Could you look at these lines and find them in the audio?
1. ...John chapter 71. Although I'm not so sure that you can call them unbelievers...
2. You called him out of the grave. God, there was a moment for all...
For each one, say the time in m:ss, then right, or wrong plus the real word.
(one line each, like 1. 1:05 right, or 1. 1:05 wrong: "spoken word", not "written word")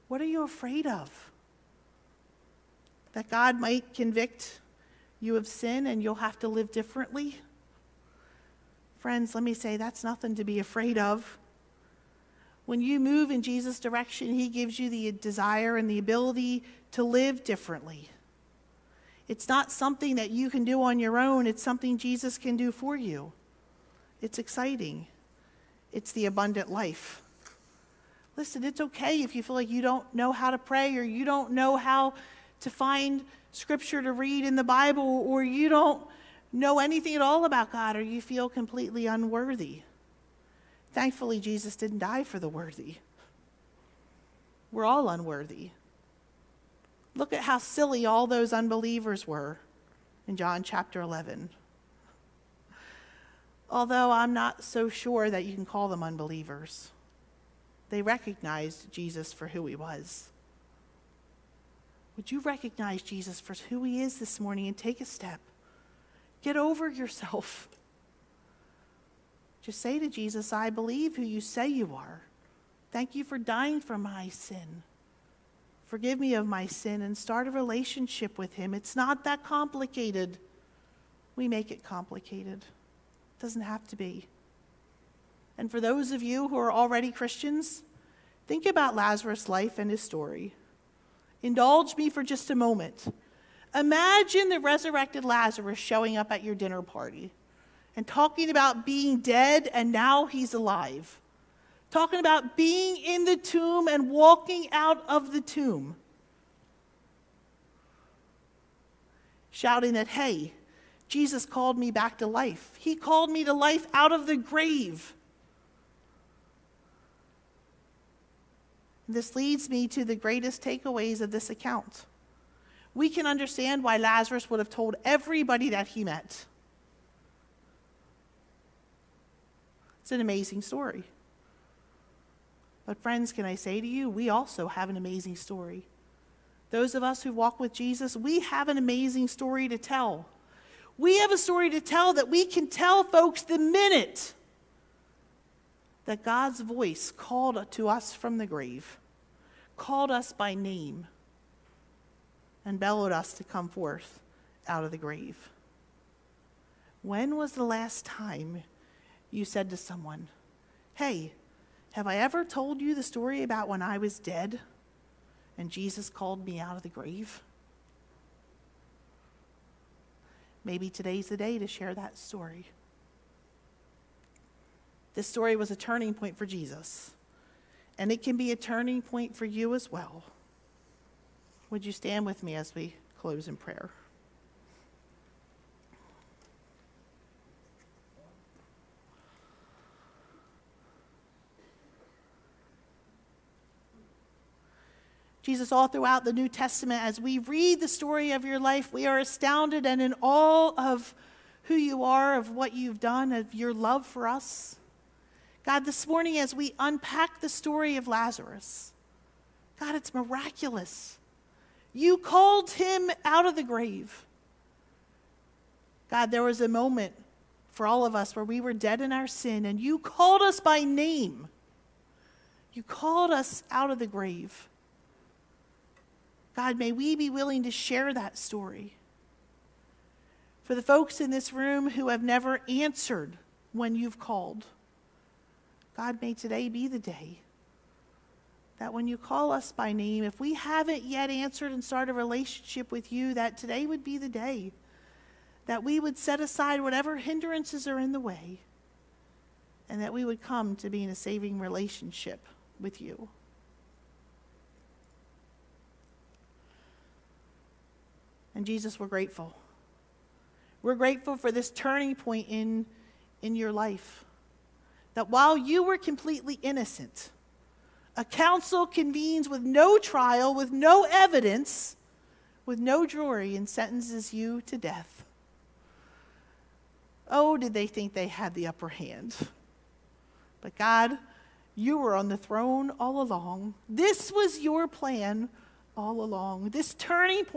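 1. 0:50 wrong: "11", not "71"
2. 3:31 right.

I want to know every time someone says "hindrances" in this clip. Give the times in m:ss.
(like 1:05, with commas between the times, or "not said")
4:07.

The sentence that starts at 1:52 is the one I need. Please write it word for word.
He called me to life out of the grave.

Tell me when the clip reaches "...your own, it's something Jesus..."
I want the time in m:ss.
0:20.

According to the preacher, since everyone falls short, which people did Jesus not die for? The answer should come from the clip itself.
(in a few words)
the worthy.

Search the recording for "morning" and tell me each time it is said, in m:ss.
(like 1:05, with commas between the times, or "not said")
1:04, 3:26.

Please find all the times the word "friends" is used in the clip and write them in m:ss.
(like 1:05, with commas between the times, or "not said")
0:08, 2:13.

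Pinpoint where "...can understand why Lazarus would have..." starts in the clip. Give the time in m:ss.
2:03.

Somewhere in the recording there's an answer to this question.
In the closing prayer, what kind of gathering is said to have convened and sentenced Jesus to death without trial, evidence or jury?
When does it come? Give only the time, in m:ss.
4:28.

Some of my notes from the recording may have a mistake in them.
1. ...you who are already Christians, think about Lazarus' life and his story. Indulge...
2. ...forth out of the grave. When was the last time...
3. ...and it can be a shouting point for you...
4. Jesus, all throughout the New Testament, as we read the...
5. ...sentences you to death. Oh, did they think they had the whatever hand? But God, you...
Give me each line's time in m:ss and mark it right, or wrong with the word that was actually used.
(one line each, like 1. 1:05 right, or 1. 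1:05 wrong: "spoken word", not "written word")
1. 1:26 right
2. 2:33 right
3. 2:57 wrong: "turning", not "shouting"
4. 3:15 right
5. 4:33 wrong: "upper", not "whatever".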